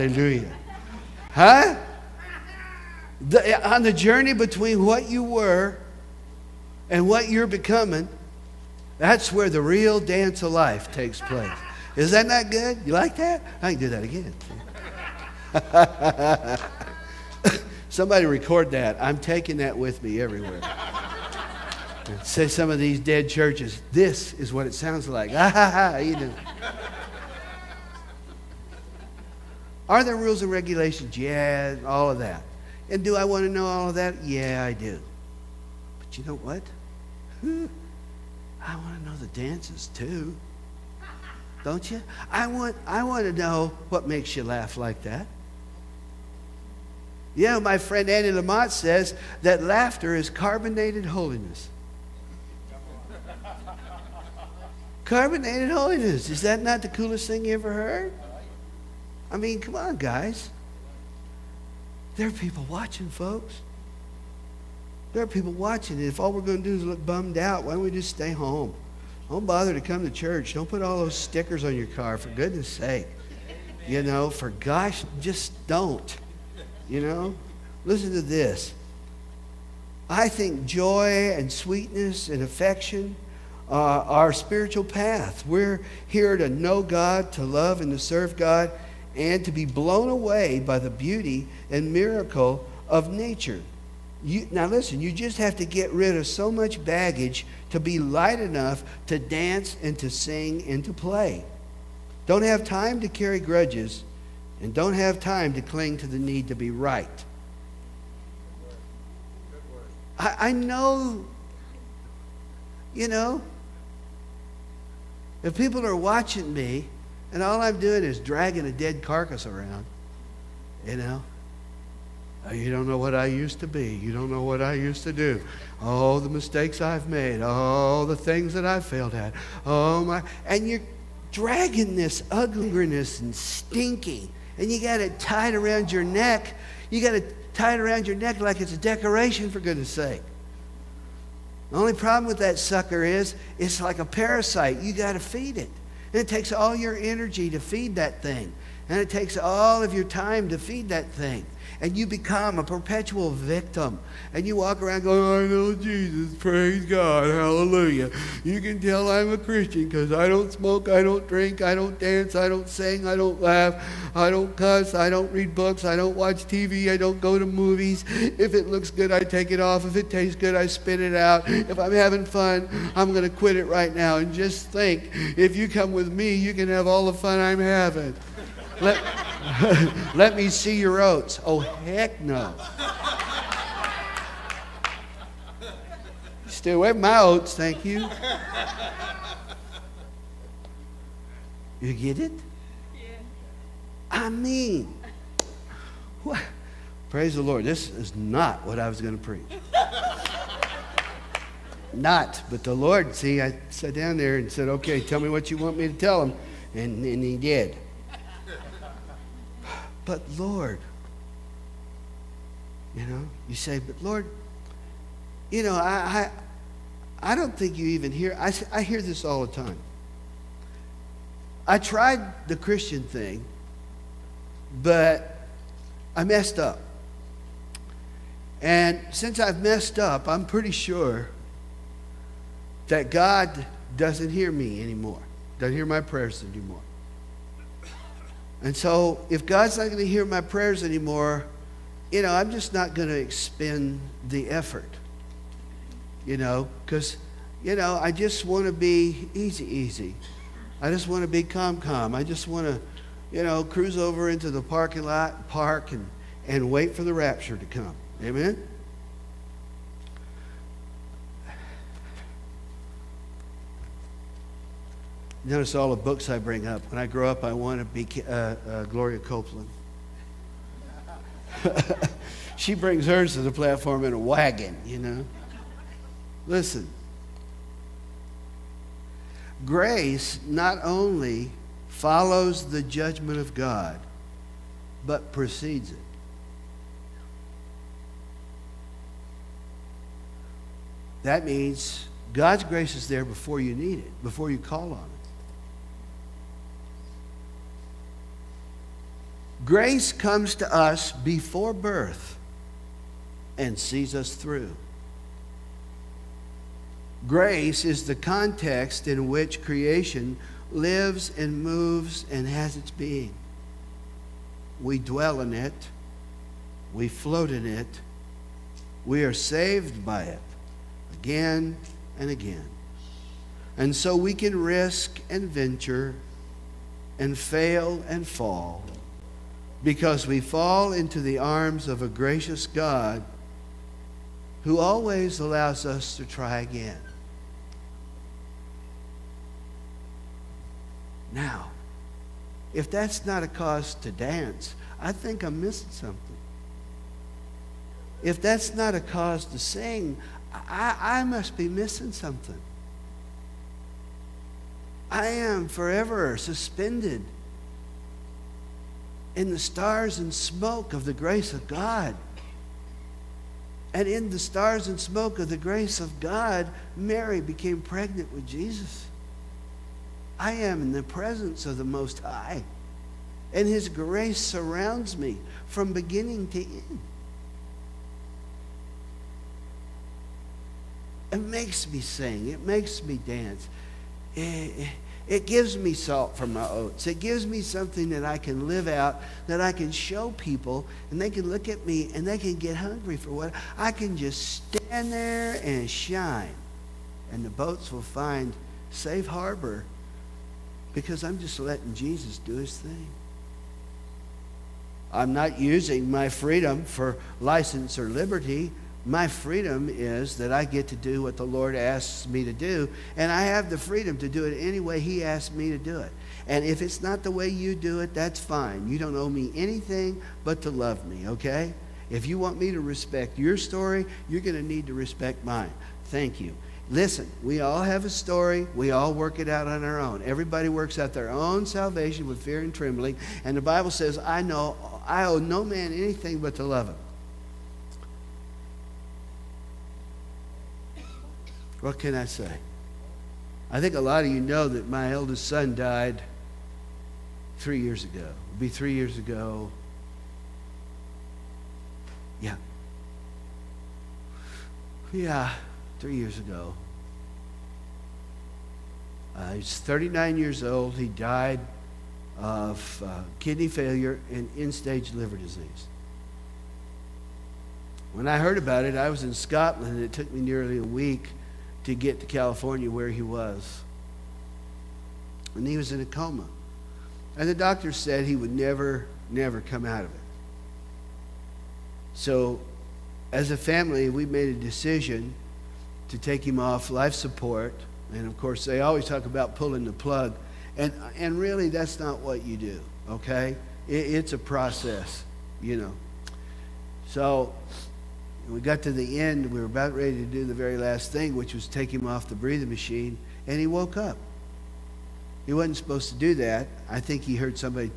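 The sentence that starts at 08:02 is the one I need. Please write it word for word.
So, as a family, we made a decision to take him off life support.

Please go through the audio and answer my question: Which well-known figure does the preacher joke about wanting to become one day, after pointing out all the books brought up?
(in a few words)
Gloria Copeland.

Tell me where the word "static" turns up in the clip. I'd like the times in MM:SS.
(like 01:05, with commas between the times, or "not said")
not said.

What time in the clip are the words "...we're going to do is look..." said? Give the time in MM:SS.
01:06.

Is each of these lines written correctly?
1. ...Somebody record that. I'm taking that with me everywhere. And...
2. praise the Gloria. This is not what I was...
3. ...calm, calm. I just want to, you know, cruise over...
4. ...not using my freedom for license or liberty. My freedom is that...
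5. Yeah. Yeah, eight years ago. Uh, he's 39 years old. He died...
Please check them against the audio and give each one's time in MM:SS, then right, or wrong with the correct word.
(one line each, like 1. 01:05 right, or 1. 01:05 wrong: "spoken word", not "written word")
1. 00:17 right
2. 03:17 wrong: "Lord", not "Gloria"
3. 04:11 right
4. 06:45 right
5. 07:32 wrong: "three", not "eight".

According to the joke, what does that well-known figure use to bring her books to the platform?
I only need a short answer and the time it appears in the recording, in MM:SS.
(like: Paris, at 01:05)
a wagon, at 04:34.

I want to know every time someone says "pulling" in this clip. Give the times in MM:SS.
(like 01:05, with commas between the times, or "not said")
08:09.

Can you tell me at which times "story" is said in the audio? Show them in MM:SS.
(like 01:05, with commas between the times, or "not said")
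07:03, 07:08.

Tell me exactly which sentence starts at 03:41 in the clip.
I tried the Christian thing, but I messed up.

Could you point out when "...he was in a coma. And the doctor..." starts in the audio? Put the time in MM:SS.
07:55.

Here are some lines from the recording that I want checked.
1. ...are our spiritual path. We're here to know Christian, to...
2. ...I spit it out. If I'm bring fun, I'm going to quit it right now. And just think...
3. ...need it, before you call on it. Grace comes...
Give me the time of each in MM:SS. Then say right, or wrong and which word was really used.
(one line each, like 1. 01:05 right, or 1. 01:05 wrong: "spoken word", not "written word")
1. 01:23 wrong: "God", not "Christian"
2. 02:50 wrong: "having", not "bring"
3. 04:53 right.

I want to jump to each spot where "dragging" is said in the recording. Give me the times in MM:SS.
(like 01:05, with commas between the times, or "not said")
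01:58, 02:11.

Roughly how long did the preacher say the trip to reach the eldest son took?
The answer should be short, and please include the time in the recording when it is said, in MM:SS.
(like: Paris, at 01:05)
nearly a week, at 07:50.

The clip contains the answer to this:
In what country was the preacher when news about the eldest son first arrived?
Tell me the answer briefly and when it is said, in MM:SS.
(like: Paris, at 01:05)
Scotland, at 07:49.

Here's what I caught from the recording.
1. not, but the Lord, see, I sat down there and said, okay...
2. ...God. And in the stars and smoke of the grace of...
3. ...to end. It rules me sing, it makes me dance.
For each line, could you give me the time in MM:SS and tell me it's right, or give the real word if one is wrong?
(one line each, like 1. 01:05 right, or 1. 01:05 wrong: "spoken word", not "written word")
1. 03:21 right
2. 06:01 right
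3. 06:16 wrong: "makes", not "rules".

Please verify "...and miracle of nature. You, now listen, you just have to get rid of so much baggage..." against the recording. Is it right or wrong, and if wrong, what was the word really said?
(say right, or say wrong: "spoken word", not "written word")
right.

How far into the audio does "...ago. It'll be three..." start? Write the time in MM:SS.
07:28.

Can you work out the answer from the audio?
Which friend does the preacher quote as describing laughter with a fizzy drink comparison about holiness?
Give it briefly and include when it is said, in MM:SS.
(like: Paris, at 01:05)
Annie Lamott, at 00:48.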